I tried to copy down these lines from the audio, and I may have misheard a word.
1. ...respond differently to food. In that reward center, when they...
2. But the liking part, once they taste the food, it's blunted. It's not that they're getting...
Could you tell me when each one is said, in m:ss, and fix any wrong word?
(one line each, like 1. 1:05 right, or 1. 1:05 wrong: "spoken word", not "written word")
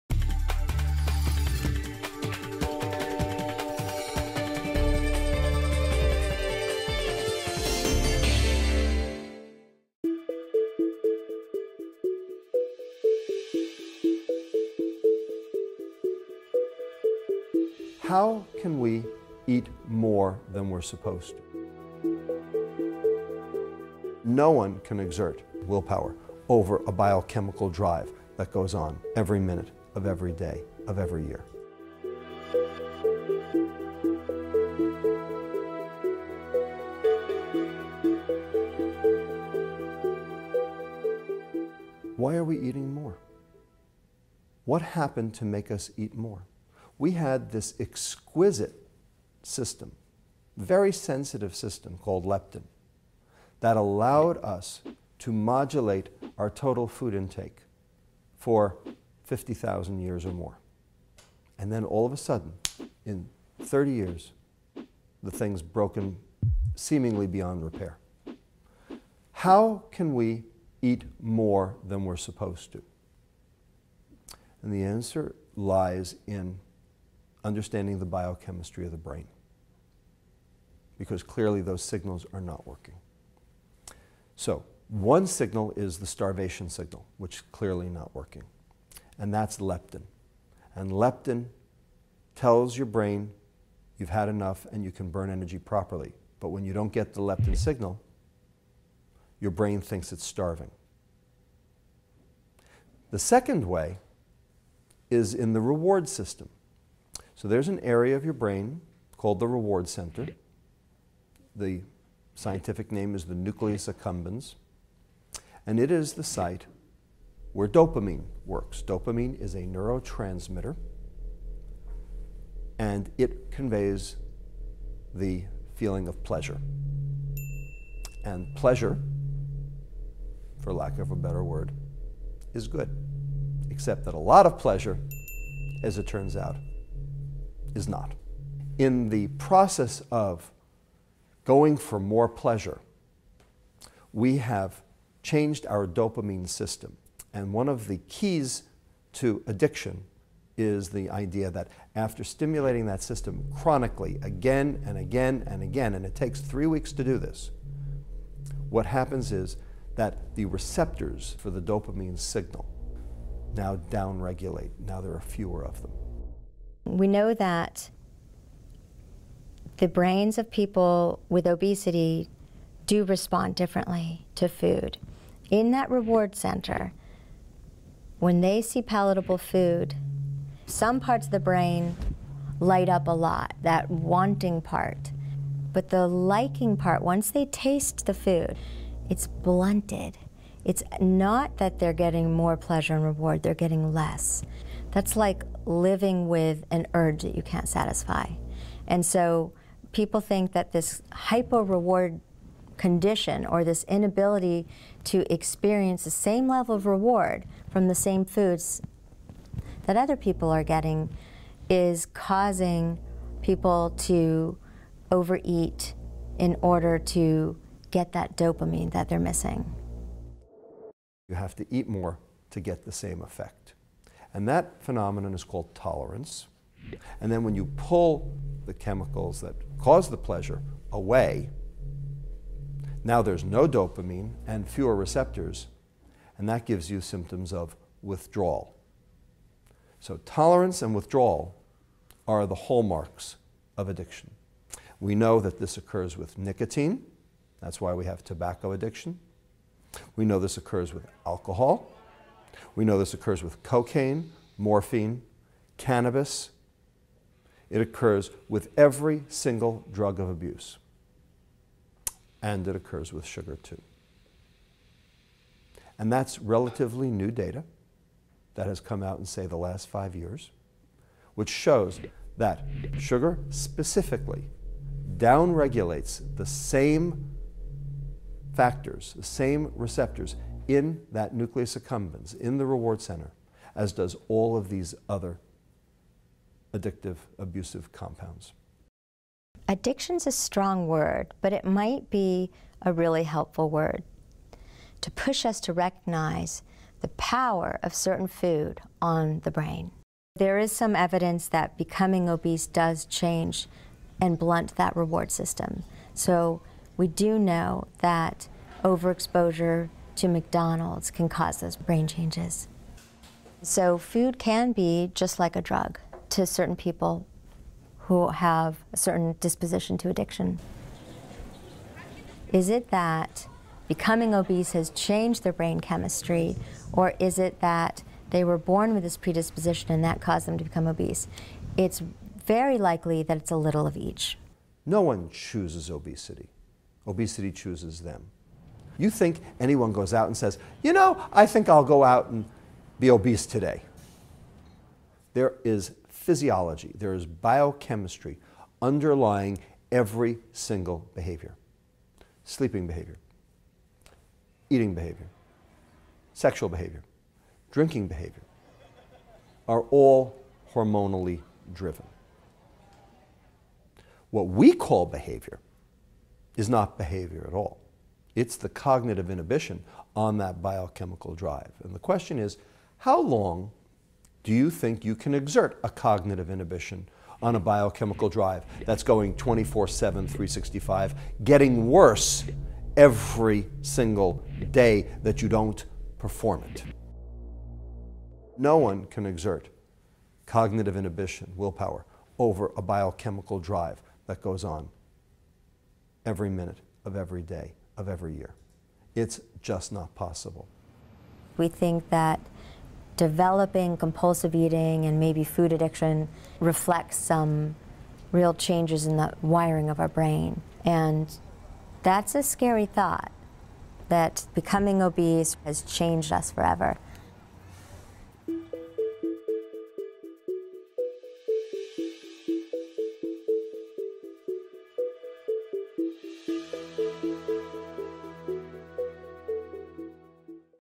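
1. 2:53 right
2. 3:05 right.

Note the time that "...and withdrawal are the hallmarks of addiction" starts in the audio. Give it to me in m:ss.
4:00.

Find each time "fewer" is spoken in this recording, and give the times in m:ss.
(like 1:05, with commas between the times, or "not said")
2:45, 3:54.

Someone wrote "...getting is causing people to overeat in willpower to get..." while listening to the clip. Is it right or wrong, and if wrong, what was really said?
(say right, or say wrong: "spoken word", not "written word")
wrong: "order", not "willpower".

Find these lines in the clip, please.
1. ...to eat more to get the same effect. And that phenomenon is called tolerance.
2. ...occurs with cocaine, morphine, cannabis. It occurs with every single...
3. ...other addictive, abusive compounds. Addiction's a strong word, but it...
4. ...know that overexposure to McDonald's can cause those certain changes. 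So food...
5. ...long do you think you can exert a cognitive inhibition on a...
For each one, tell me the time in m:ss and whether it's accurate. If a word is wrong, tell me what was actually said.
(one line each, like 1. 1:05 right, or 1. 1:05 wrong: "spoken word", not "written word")
1. 3:41 right
2. 4:13 right
3. 4:45 right
4. 5:07 wrong: "brain", not "certain"
5. 6:13 right.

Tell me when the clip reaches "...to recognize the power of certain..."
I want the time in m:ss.
4:55.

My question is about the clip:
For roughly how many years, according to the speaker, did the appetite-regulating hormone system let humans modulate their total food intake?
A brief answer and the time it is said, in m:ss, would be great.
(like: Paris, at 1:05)
50,000 years, at 0:59.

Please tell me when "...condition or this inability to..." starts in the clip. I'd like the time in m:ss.
3:22.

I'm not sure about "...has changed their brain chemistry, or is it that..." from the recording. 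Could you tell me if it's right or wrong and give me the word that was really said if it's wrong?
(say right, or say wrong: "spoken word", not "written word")
right.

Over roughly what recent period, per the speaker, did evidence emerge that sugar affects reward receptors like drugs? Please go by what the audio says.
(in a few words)
the last five years.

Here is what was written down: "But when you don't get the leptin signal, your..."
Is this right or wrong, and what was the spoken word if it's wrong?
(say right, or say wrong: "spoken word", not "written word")
right.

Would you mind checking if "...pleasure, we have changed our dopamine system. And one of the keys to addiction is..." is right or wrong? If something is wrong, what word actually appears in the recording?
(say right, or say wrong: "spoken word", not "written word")
right.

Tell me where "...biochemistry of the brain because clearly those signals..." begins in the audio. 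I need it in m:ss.
1:18.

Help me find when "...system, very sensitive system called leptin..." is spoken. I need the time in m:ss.
0:49.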